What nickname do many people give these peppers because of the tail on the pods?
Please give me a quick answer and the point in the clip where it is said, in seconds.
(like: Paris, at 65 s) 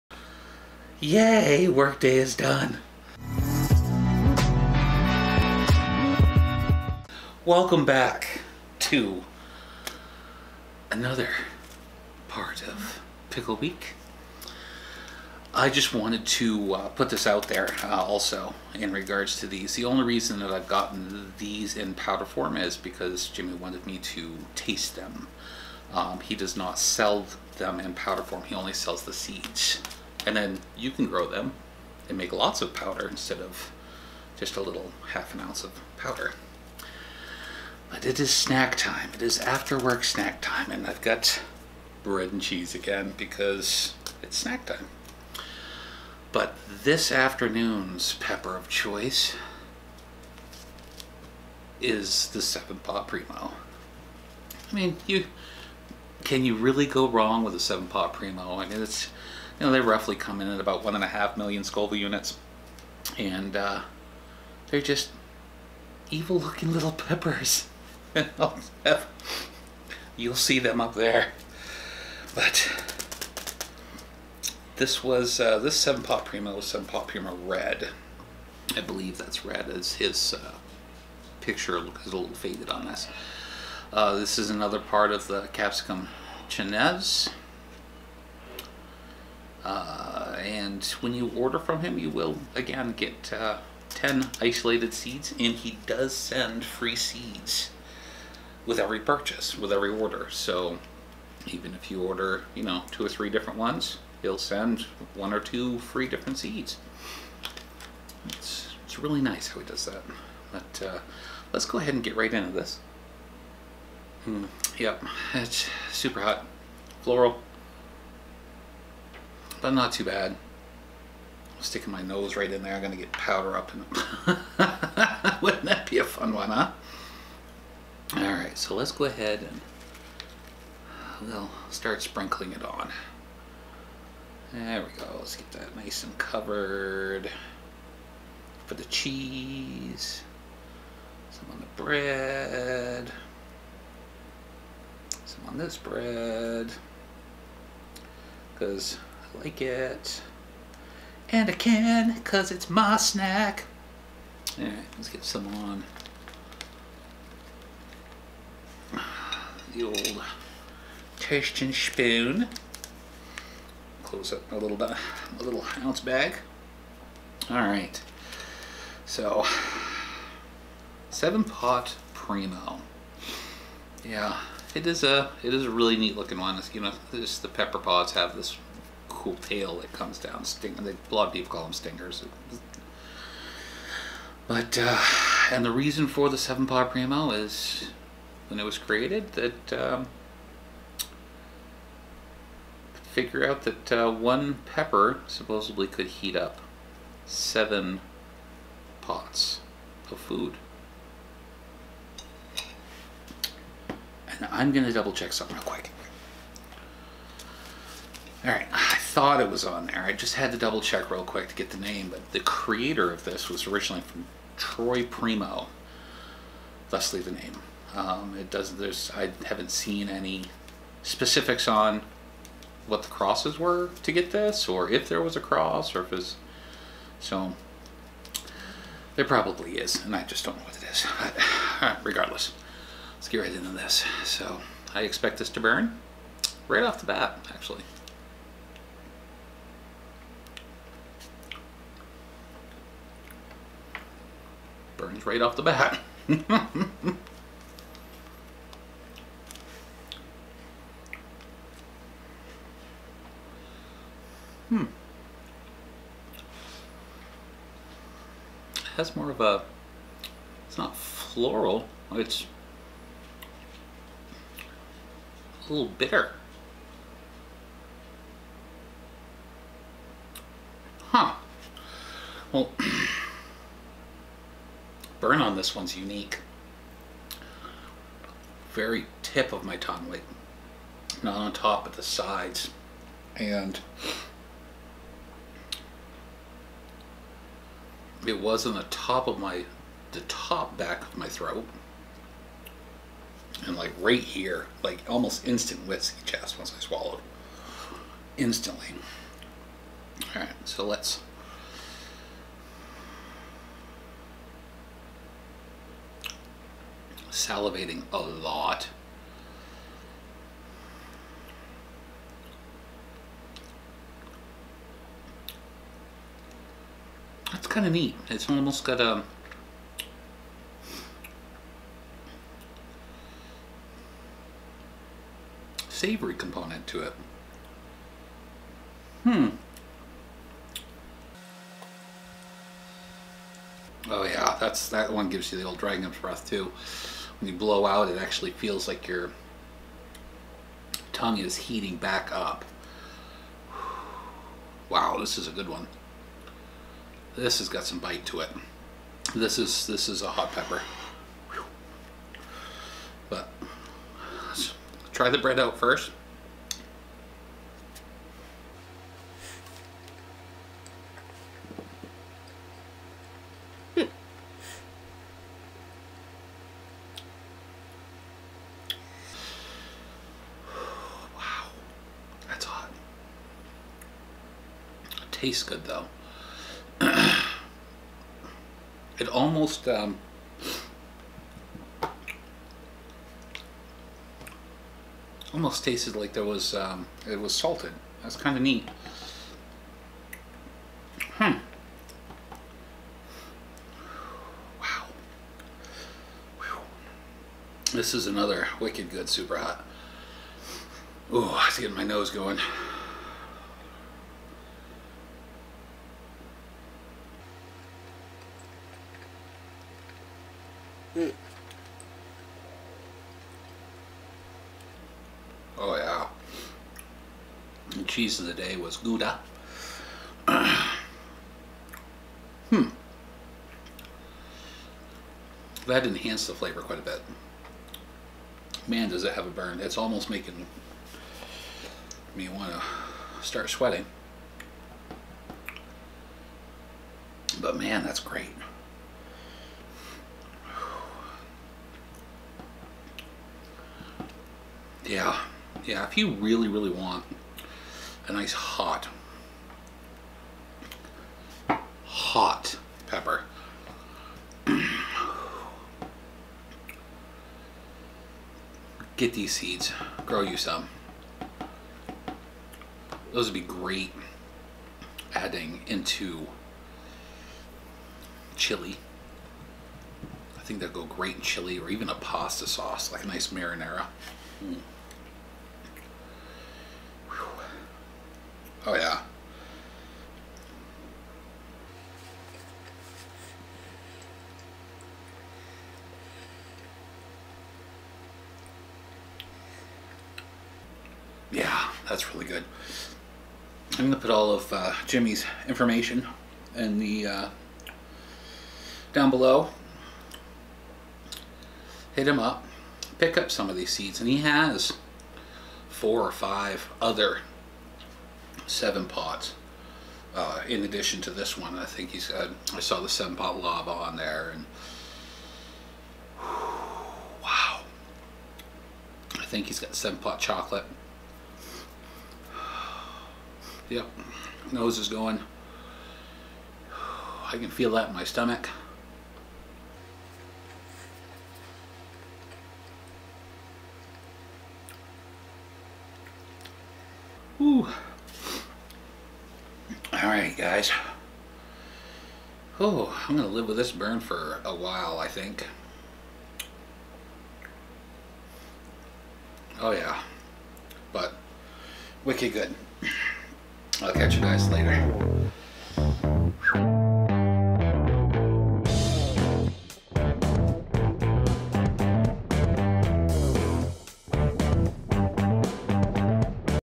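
Stingers, at 181 s.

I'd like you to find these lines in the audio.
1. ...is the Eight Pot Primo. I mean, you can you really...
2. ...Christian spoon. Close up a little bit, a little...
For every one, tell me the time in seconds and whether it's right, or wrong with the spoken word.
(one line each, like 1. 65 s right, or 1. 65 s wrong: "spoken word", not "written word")
1. 51 s wrong: "Seven", not "Eight"
2. 161 s right.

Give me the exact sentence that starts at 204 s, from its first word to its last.
And I'm going to double check something real quick.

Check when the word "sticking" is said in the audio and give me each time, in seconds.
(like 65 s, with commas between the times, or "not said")
121 s.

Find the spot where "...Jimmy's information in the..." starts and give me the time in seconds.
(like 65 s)
495 s.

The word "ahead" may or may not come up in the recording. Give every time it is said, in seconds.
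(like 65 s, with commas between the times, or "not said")
111 s, 129 s.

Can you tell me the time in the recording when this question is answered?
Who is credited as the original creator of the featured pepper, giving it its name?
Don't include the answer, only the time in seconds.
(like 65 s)
214 s.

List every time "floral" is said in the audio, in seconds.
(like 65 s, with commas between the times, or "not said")
117 s, 260 s.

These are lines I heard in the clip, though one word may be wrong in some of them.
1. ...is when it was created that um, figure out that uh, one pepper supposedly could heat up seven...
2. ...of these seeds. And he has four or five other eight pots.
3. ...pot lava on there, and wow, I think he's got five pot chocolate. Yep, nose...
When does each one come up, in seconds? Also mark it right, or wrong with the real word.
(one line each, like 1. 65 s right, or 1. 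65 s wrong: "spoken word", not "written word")
1. 187 s right
2. 503 s wrong: "seven", not "eight"
3. 513 s wrong: "seven", not "five".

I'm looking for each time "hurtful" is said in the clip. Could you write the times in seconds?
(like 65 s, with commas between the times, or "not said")
not said.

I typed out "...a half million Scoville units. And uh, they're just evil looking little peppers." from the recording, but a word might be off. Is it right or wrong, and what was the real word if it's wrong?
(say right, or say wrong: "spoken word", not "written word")
right.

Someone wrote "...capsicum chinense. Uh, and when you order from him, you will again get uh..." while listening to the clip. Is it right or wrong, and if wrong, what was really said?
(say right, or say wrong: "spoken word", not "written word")
right.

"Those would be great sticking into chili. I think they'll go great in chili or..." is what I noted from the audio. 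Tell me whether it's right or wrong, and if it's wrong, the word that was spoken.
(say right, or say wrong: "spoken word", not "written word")
wrong: "adding", not "sticking".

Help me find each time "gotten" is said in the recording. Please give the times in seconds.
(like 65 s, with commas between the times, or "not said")
20 s.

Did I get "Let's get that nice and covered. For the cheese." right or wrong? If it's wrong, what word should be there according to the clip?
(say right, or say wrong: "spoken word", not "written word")
right.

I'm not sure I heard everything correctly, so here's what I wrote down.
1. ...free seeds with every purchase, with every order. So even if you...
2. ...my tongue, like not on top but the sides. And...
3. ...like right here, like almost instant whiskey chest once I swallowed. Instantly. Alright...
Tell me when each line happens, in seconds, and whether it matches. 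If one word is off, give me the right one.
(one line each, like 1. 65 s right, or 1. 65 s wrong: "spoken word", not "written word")
1. 96 s right
2. 279 s right
3. 293 s right.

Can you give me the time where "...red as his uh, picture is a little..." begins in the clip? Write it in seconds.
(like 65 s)
79 s.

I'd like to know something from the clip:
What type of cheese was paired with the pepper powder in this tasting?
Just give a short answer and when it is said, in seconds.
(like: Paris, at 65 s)
Gouda, at 418 s.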